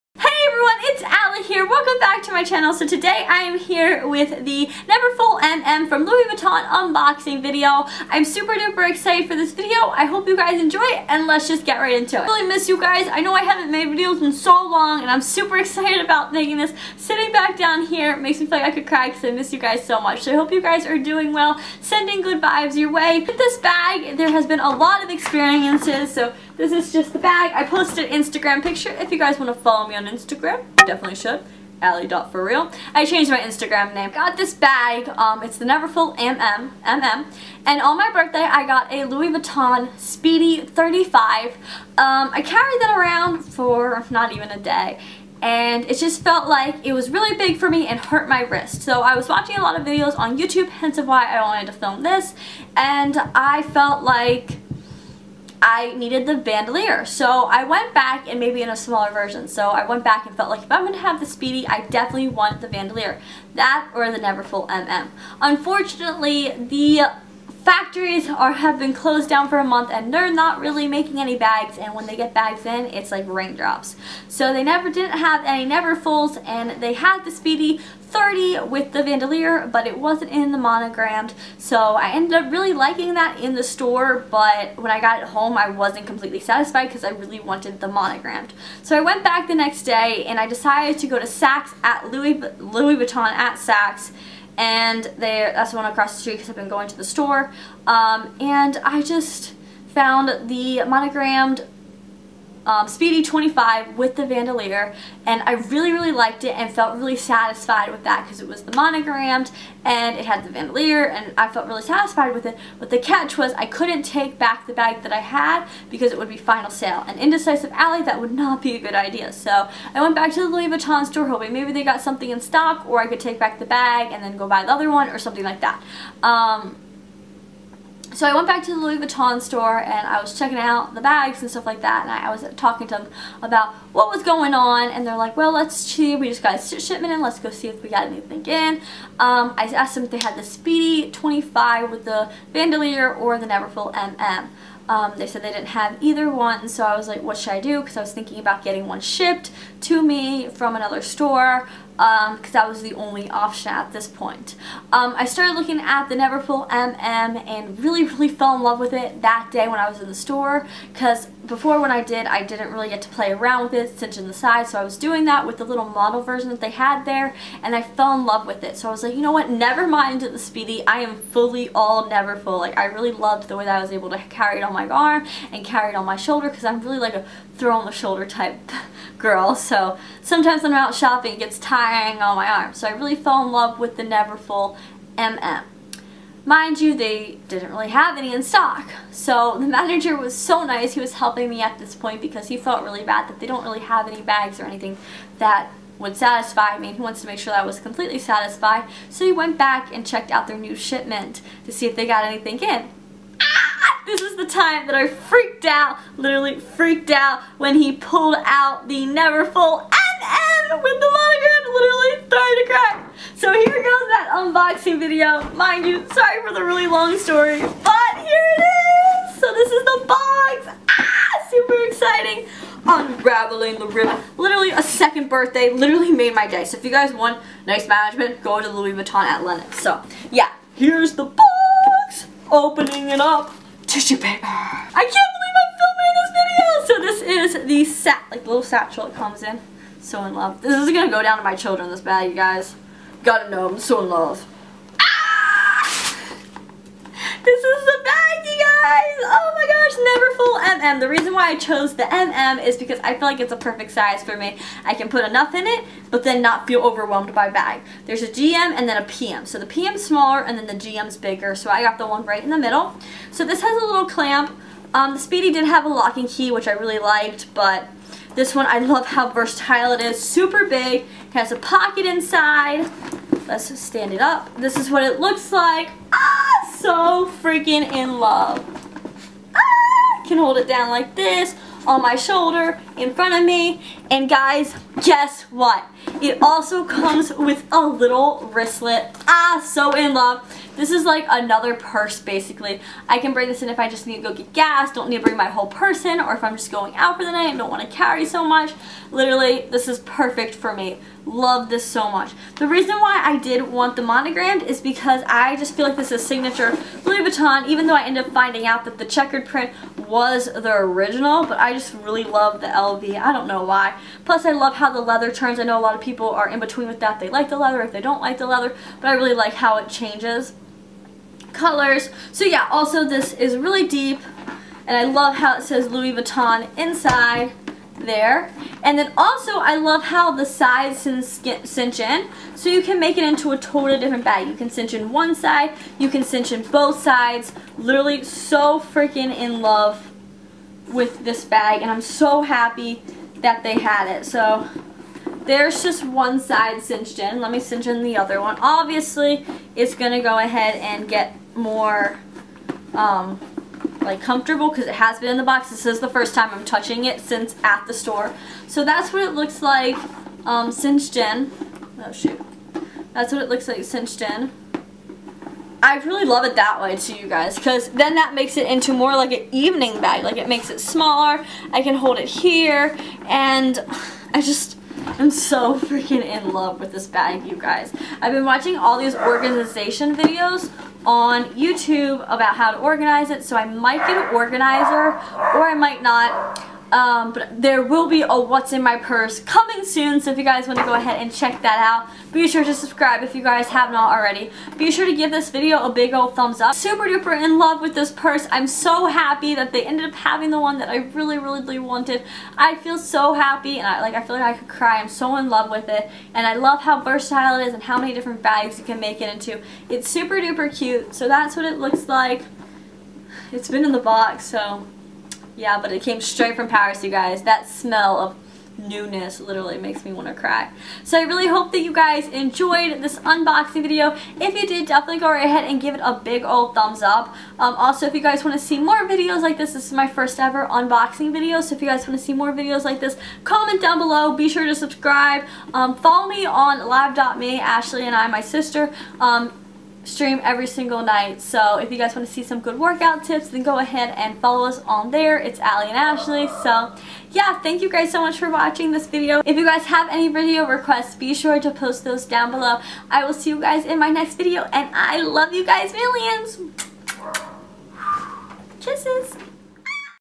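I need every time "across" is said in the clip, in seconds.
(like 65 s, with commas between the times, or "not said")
95 s.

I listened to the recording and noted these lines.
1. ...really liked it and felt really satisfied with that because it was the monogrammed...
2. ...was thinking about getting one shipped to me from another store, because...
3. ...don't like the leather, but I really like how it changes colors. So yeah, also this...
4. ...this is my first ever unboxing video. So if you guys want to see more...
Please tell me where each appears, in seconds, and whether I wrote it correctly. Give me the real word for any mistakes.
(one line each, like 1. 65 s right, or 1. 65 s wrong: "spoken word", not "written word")
1. 105 s right
2. 148 s right
3. 318 s right
4. 429 s right.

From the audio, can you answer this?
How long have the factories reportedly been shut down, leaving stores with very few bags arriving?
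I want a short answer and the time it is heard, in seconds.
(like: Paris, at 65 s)
A month, at 69 s.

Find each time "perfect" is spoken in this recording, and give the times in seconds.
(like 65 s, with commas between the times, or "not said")
253 s, 299 s.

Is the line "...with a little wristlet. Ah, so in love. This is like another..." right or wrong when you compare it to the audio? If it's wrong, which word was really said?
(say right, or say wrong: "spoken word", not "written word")
right.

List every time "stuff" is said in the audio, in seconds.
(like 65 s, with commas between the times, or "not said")
131 s.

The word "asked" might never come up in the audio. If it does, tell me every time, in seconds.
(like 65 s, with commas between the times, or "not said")
139 s.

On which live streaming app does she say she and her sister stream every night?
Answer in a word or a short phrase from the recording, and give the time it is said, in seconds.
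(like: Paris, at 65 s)
live.me, at 436 s.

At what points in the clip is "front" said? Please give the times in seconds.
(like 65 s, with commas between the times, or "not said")
283 s.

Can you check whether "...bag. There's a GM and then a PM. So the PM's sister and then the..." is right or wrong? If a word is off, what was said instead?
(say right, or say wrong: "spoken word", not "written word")
wrong: "smaller", not "sister".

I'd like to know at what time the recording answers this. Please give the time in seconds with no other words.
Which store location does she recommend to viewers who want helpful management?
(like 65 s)
229 s.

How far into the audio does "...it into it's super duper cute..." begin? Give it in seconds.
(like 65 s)
409 s.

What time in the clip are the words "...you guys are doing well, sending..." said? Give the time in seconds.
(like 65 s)
20 s.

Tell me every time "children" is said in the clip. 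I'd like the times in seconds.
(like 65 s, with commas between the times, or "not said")
241 s.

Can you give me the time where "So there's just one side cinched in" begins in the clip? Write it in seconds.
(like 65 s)
344 s.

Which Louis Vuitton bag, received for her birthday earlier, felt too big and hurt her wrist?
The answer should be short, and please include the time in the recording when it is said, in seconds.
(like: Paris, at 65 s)
Speedy 35, at 39 s.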